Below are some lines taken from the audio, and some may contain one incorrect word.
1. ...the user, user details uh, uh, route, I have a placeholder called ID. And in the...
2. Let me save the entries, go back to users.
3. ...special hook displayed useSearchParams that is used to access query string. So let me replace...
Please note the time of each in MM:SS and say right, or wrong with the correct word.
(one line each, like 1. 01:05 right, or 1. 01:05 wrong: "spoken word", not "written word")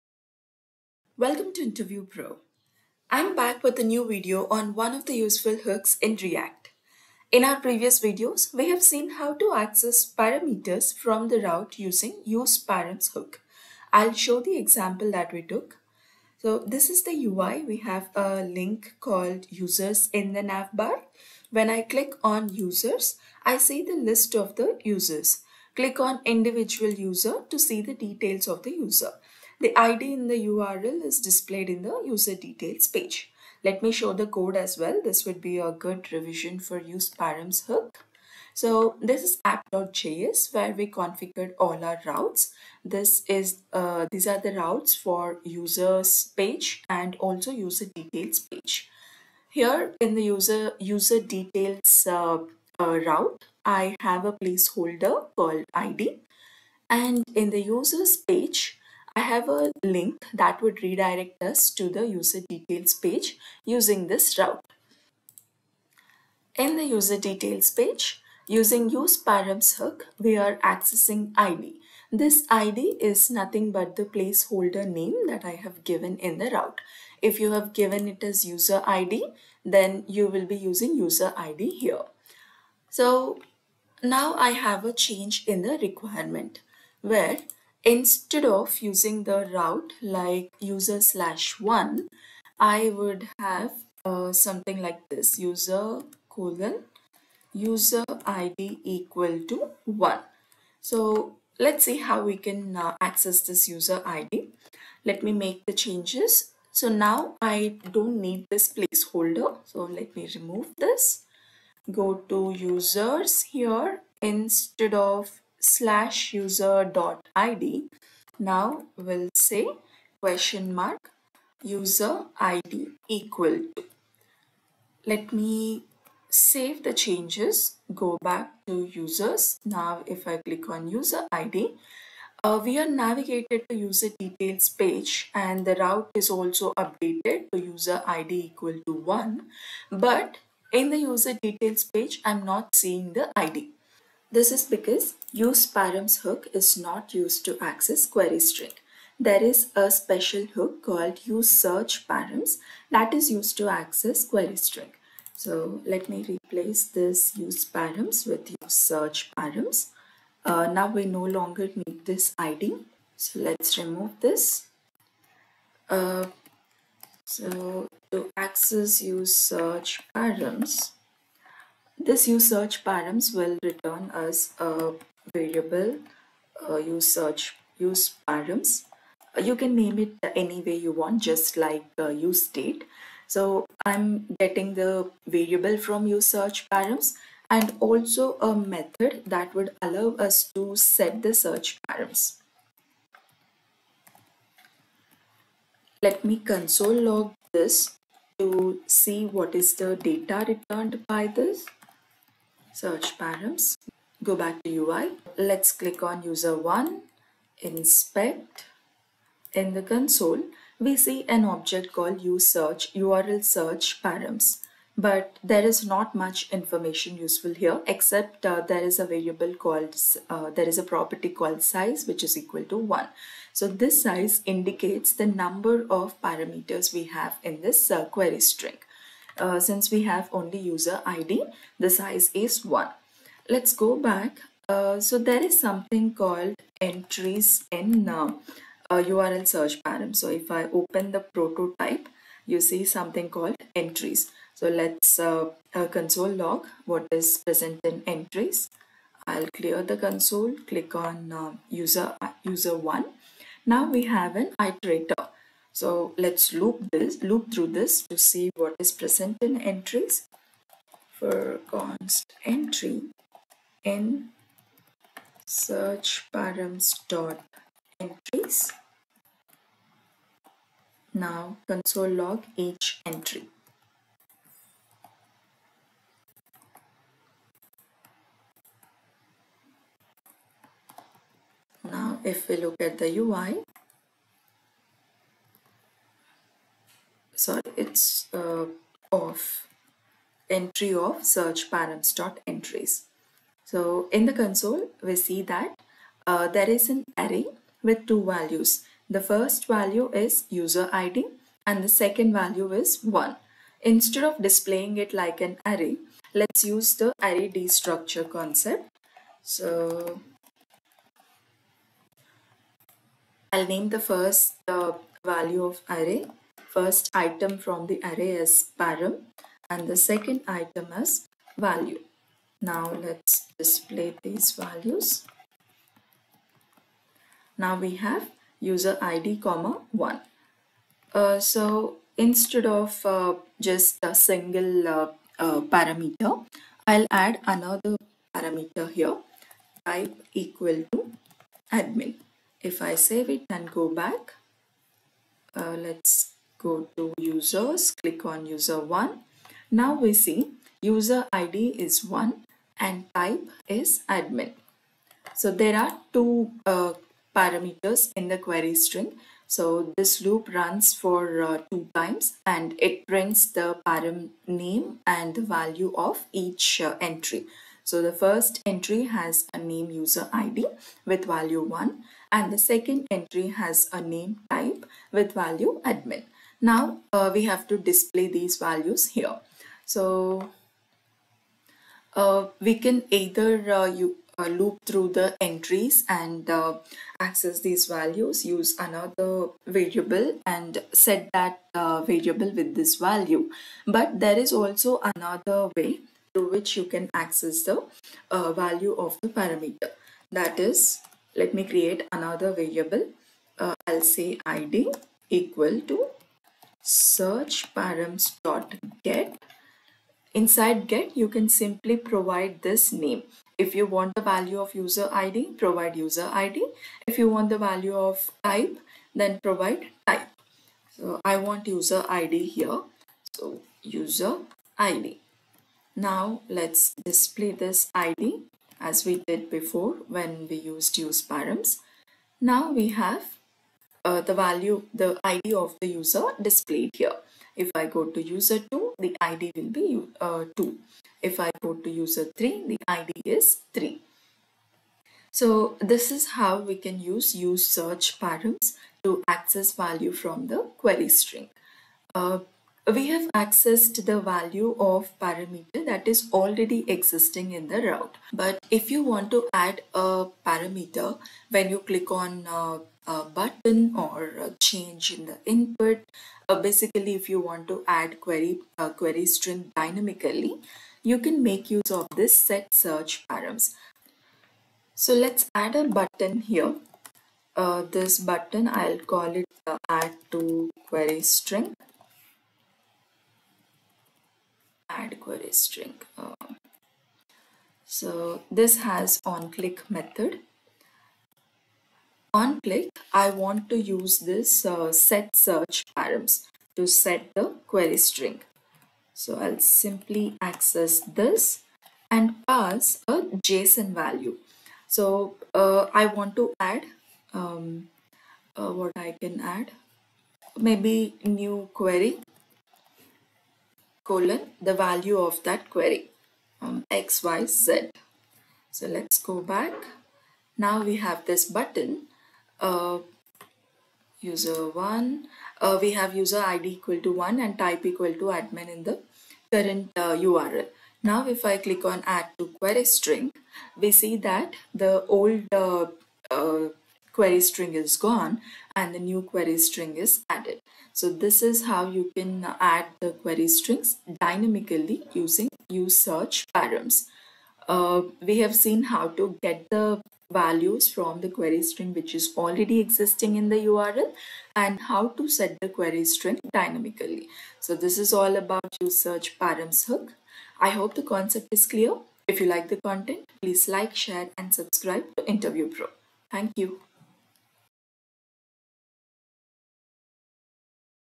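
1. 00:50 right
2. 02:05 wrong: "changes", not "entries"
3. 02:29 wrong: "called", not "displayed".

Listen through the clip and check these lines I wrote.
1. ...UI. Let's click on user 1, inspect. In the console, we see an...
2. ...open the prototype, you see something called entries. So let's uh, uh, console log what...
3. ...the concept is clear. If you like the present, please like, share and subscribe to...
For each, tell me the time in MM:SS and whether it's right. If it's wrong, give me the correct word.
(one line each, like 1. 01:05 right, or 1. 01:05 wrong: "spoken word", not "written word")
1. 03:24 right
2. 04:00 right
3. 09:20 wrong: "content", not "present".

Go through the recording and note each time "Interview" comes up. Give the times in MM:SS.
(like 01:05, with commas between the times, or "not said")
00:01, 09:25.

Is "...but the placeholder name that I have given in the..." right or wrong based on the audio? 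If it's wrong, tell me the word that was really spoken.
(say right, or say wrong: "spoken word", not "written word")
right.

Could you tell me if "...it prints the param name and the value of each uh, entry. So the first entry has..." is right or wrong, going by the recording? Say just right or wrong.
right.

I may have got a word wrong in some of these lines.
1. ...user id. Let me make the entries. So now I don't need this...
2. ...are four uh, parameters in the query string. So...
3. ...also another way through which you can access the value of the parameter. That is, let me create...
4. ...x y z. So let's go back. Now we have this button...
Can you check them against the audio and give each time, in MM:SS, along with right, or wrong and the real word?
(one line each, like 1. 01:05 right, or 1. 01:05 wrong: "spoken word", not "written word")
1. 01:43 wrong: "changes", not "entries"
2. 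05:55 wrong: "two", not "four"
3. 06:34 right
4. 08:36 right.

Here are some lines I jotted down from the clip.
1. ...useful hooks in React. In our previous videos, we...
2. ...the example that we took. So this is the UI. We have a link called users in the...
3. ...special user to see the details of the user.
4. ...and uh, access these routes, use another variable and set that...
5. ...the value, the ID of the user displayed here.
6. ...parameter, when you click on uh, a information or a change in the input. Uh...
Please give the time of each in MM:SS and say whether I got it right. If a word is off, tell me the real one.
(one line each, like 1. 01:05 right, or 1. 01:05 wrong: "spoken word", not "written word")
1. 00:05 right
2. 00:14 right
3. 00:26 wrong: "individual", not "special"
4. 06:26 wrong: "values", not "routes"
5. 07:14 right
6. 07:40 wrong: "button", not "information".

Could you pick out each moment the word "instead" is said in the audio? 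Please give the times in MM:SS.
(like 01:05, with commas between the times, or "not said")
01:27, 01:54, 05:03, 05:32.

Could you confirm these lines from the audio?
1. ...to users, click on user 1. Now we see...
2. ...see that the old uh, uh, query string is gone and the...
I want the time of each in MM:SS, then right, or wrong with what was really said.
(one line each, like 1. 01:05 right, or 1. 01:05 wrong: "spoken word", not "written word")
1. 05:46 right
2. 08:54 right.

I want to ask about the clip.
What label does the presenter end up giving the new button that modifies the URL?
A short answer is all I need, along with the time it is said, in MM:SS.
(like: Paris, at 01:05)
Add query string, at 08:04.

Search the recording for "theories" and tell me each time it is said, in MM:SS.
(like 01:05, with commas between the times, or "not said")
not said.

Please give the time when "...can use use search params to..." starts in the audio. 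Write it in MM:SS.
07:26.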